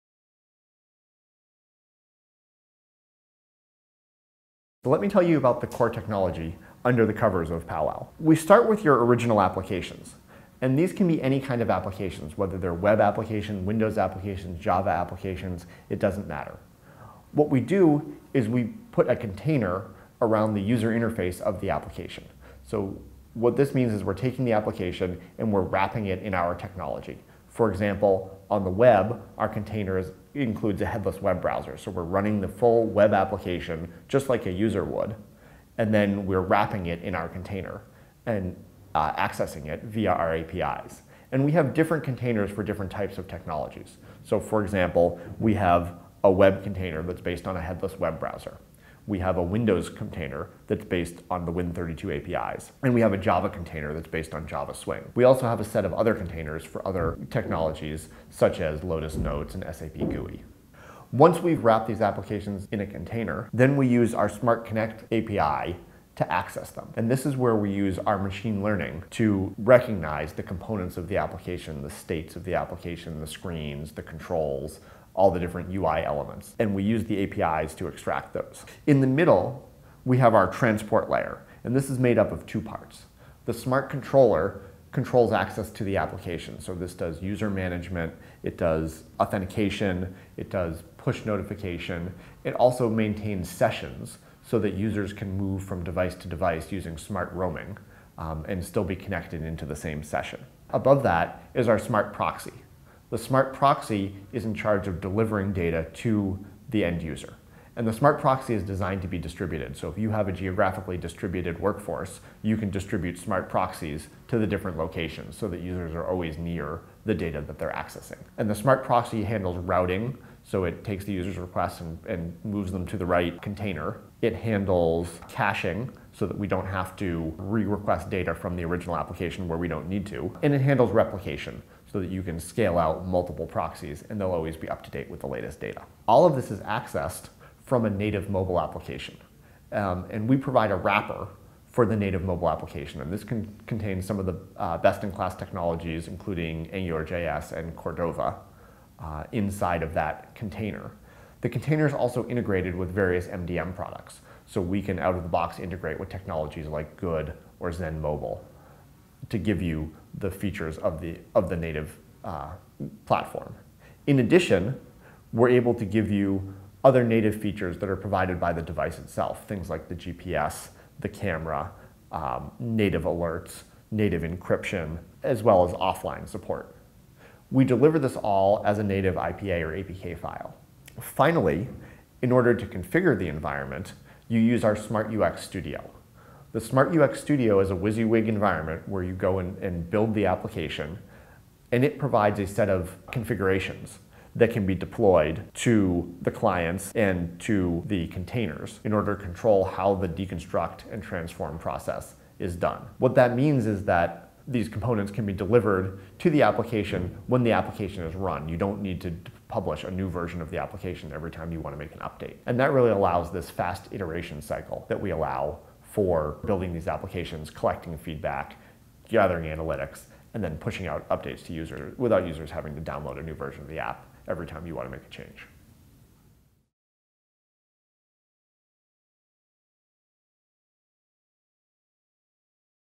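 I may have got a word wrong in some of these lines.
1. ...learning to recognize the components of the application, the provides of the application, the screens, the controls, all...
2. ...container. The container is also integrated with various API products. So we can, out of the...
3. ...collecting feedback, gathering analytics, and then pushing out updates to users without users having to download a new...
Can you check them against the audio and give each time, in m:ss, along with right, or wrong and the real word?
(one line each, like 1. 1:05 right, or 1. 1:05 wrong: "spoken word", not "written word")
1. 1:08 wrong: "states", not "provides"
2. 2:30 wrong: "MDM", not "API"
3. 3:37 right.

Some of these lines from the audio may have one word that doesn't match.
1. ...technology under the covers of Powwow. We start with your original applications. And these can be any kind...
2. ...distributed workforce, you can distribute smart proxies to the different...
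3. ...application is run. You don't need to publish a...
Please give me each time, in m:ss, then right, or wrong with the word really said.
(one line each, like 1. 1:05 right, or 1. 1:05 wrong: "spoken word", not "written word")
1. 0:05 right
2. 1:50 right
3. 3:27 right.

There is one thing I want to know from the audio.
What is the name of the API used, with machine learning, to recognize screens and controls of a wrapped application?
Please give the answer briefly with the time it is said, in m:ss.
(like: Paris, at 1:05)
Smart Connect, at 1:04.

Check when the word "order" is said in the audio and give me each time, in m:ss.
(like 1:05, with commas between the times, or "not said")
3:02, 3:18.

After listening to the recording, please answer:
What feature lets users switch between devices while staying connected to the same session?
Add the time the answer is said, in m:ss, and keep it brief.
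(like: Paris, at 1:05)
smart roaming, at 1:36.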